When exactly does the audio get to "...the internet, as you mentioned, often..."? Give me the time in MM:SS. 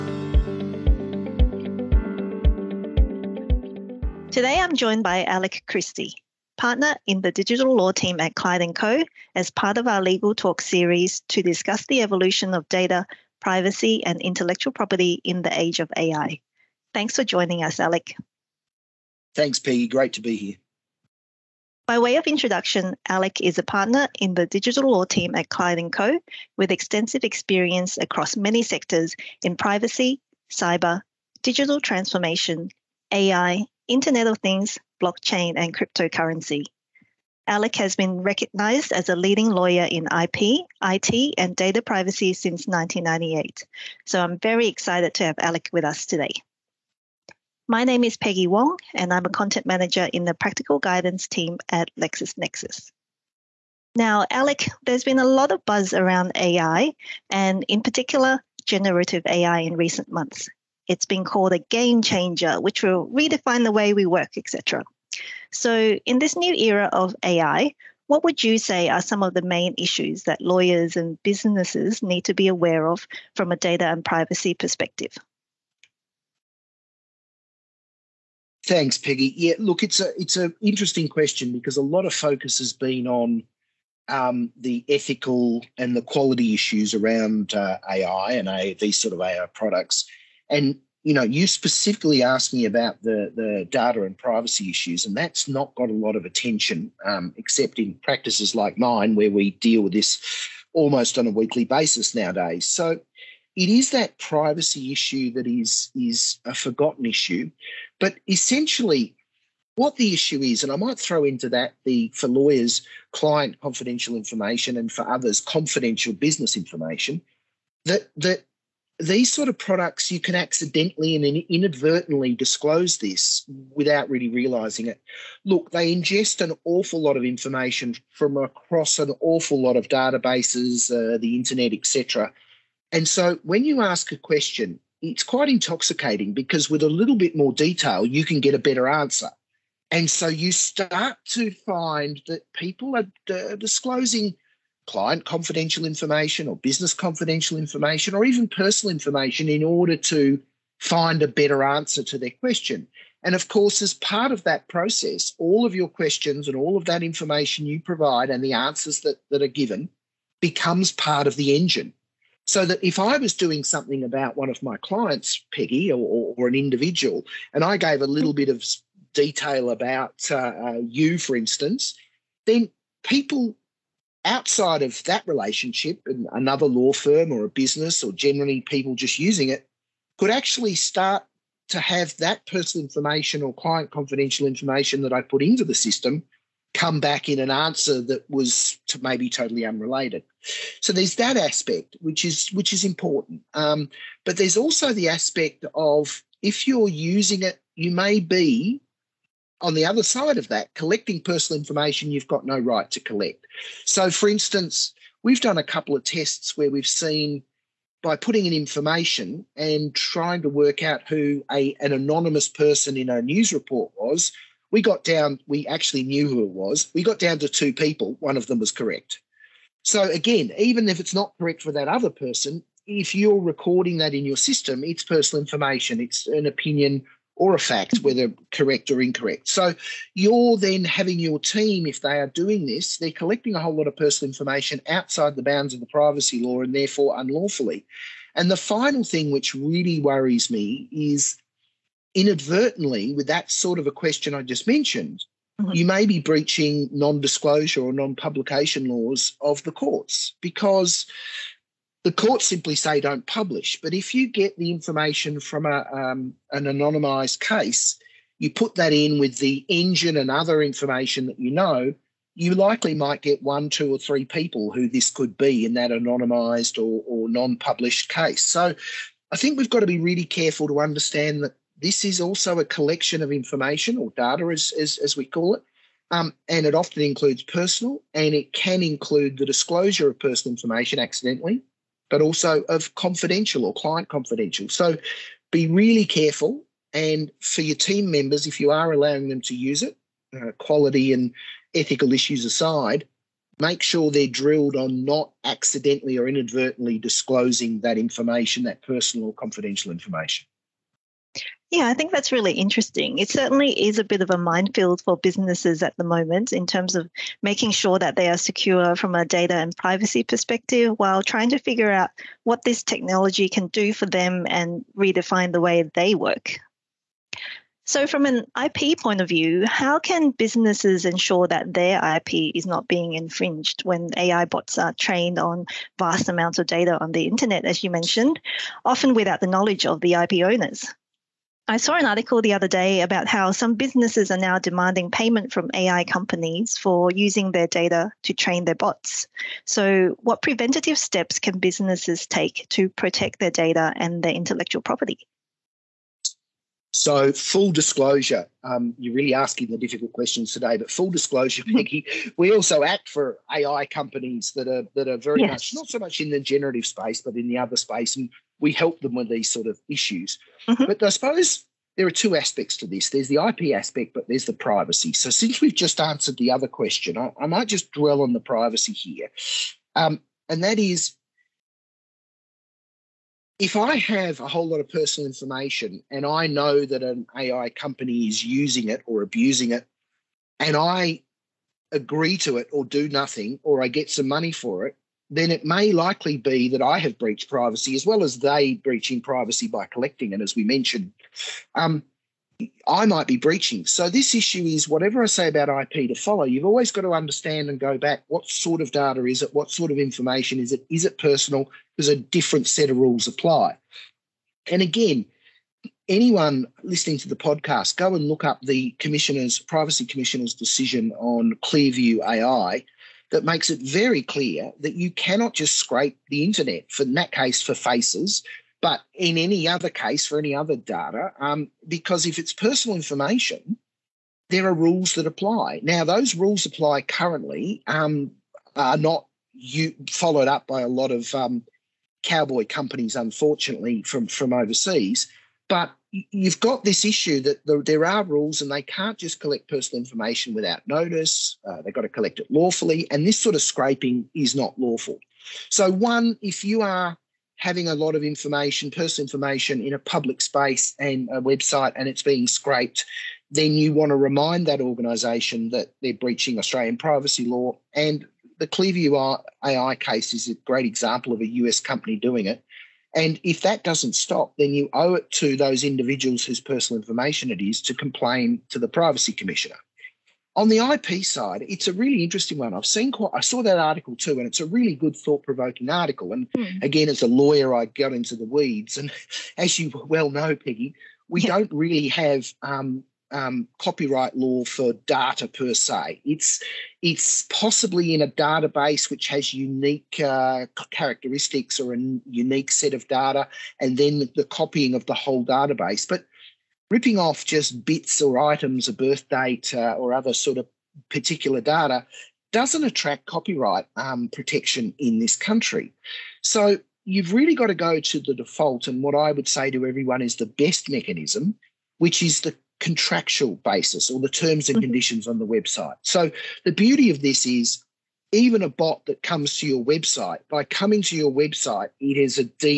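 05:27.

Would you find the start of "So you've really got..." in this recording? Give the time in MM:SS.
08:26.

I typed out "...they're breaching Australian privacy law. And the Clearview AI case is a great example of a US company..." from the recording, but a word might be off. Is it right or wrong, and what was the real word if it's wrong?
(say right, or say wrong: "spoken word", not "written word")
right.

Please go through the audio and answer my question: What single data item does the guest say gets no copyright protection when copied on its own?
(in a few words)
A birth date.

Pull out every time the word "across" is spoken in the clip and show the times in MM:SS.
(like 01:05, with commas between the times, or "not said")
00:27, 02:08.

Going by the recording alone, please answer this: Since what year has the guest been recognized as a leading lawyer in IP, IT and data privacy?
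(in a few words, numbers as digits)
1998.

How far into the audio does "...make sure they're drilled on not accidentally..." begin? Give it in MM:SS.
04:53.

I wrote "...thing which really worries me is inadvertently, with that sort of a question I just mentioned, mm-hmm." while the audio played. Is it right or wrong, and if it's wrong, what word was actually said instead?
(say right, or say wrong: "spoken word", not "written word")
right.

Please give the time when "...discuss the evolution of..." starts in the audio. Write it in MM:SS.
00:11.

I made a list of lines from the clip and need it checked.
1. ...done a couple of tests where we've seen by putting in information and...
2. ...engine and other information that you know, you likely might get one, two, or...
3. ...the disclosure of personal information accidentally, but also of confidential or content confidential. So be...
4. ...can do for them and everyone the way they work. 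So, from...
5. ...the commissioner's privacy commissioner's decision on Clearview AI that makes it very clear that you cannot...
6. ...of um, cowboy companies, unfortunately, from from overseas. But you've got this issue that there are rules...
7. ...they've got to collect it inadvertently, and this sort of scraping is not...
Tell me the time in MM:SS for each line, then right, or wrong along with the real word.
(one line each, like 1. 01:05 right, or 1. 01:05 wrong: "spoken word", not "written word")
1. 03:25 right
2. 04:19 right
3. 04:39 wrong: "client", not "content"
4. 05:13 wrong: "redefine", not "everyone"
5. 06:48 right
6. 07:11 right
7. 07:21 wrong: "lawfully", not "inadvertently".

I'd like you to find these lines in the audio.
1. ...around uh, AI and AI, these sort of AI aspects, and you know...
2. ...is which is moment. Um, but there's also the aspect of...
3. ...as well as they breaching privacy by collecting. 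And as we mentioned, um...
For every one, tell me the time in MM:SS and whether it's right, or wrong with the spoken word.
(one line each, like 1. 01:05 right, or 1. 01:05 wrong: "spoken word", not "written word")
1. 01:26 wrong: "products", not "aspects"
2. 03:12 wrong: "important", not "moment"
3. 06:27 right.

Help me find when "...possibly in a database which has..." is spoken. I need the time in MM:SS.
08:07.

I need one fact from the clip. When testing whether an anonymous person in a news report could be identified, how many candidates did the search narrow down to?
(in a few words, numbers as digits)
2.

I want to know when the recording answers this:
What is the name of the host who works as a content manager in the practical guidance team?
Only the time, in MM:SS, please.
00:48.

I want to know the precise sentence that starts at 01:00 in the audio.
It's been called a game changer, which will redefine the way we work, etc.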